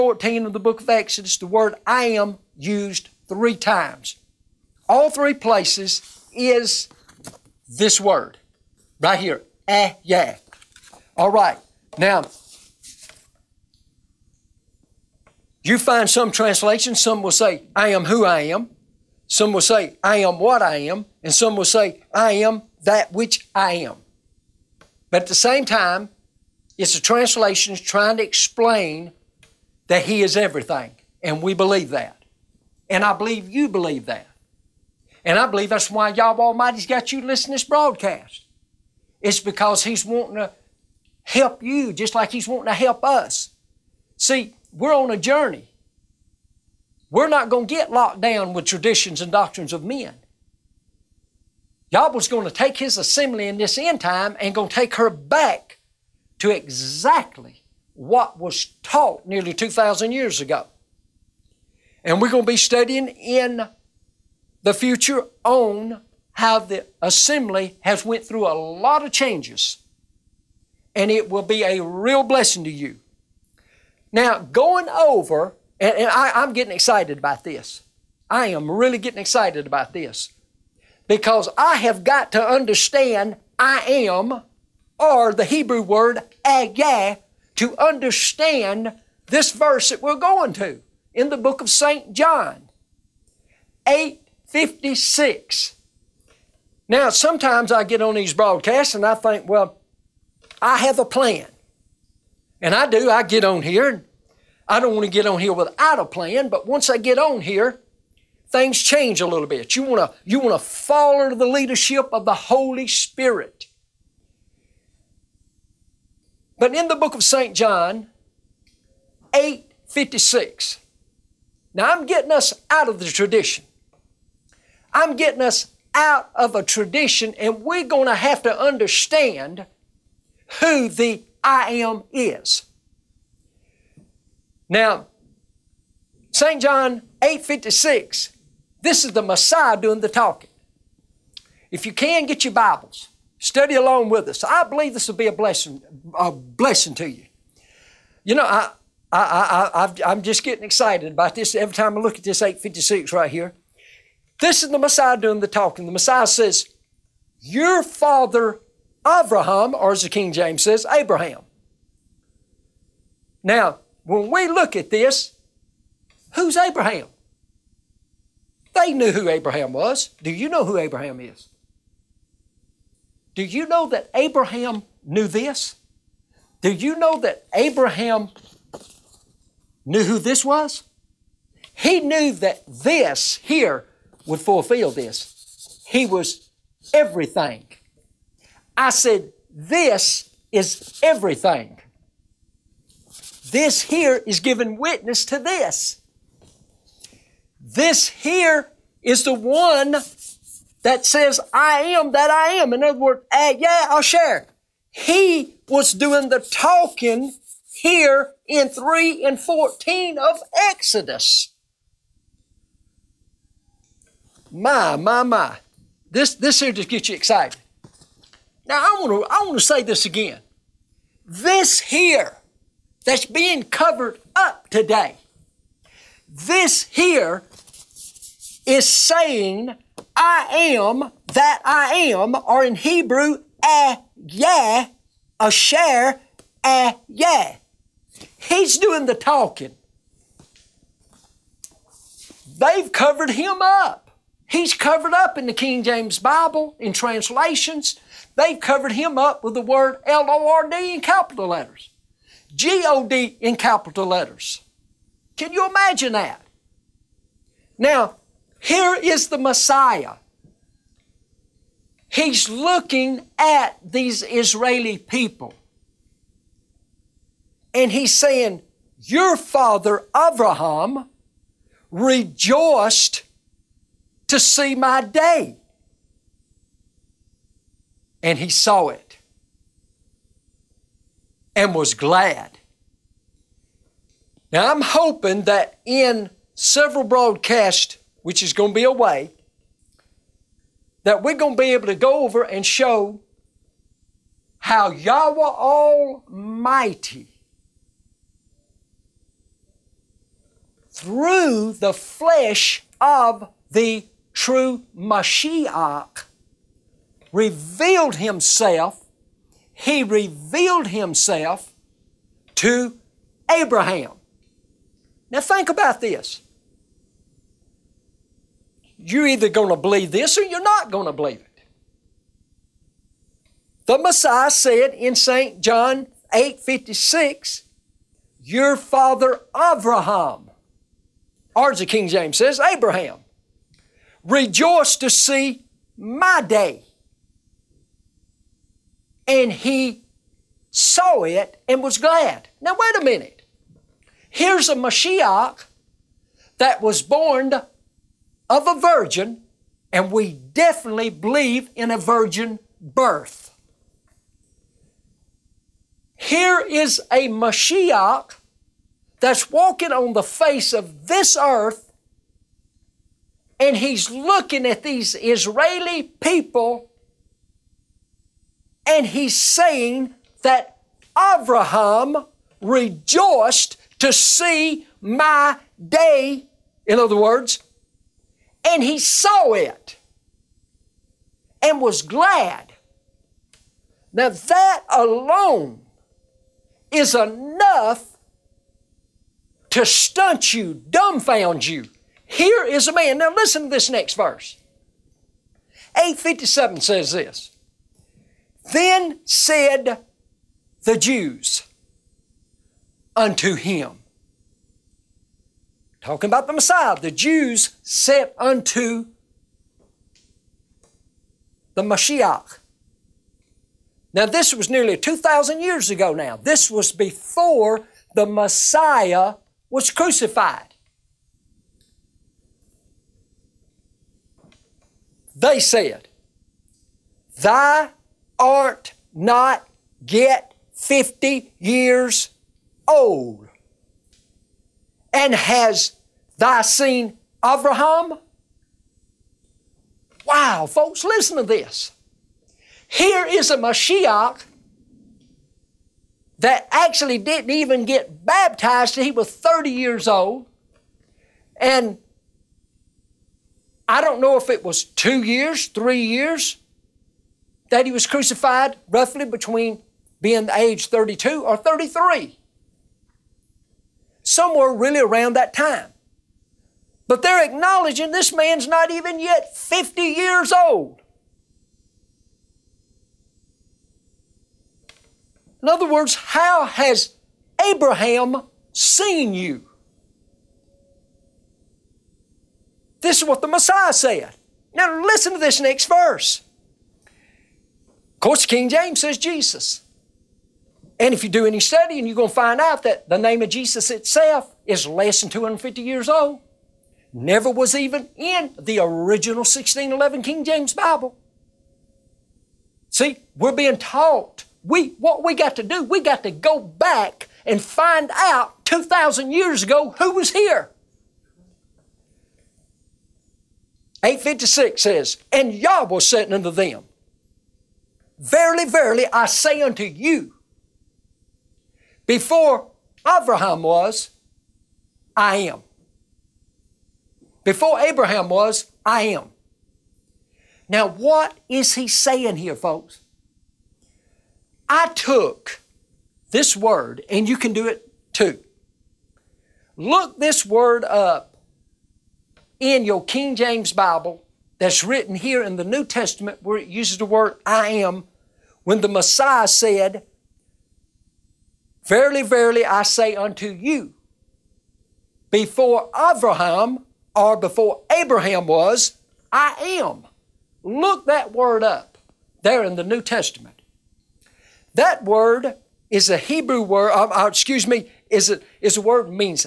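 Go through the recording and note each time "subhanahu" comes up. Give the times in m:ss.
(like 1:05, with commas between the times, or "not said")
not said.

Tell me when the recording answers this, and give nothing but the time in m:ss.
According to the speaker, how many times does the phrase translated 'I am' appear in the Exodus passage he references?
0:03.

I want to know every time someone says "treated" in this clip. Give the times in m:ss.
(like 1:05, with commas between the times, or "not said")
not said.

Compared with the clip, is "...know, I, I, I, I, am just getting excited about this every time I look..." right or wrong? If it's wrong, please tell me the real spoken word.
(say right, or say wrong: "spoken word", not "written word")
right.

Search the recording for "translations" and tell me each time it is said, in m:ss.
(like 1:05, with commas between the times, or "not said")
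0:16, 0:27, 4:06.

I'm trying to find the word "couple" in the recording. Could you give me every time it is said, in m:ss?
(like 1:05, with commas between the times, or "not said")
not said.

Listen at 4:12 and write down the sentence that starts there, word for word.
G O D in capital letters.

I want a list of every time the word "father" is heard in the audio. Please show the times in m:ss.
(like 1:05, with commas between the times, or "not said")
2:37, 4:29, 5:28.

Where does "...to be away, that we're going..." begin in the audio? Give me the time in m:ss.
4:48.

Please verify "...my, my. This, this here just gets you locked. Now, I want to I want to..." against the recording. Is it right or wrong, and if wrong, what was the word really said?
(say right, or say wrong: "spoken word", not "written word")
wrong: "excited", not "locked".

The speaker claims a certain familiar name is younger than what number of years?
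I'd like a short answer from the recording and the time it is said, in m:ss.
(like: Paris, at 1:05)
250, at 8:15.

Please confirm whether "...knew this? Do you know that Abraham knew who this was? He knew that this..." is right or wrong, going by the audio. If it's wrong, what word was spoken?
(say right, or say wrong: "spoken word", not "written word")
right.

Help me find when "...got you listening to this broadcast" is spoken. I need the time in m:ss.
0:36.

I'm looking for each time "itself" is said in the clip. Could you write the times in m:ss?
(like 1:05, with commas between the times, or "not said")
8:13.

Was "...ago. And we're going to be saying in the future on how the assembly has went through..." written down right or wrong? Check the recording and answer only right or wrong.
wrong.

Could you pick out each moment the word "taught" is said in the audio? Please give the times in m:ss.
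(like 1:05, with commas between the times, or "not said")
0:58, 8:23.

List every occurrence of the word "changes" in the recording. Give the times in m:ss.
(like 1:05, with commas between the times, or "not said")
1:09, 1:48.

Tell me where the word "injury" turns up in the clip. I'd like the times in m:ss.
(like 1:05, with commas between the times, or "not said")
not said.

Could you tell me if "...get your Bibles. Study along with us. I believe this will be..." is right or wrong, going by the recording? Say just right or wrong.
right.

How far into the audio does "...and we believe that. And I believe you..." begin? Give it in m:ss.
0:31.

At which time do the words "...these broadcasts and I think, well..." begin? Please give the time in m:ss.
1:38.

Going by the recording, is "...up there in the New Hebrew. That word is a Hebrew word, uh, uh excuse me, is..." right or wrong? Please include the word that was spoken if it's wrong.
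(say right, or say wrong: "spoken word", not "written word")
wrong: "Testament", not "Hebrew".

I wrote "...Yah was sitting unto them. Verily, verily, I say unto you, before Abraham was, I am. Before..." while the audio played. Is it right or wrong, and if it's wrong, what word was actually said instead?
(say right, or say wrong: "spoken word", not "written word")
right.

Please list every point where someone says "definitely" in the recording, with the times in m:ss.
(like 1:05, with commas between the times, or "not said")
5:50.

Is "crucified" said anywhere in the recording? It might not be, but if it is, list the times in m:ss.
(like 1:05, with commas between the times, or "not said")
6:59, 7:38.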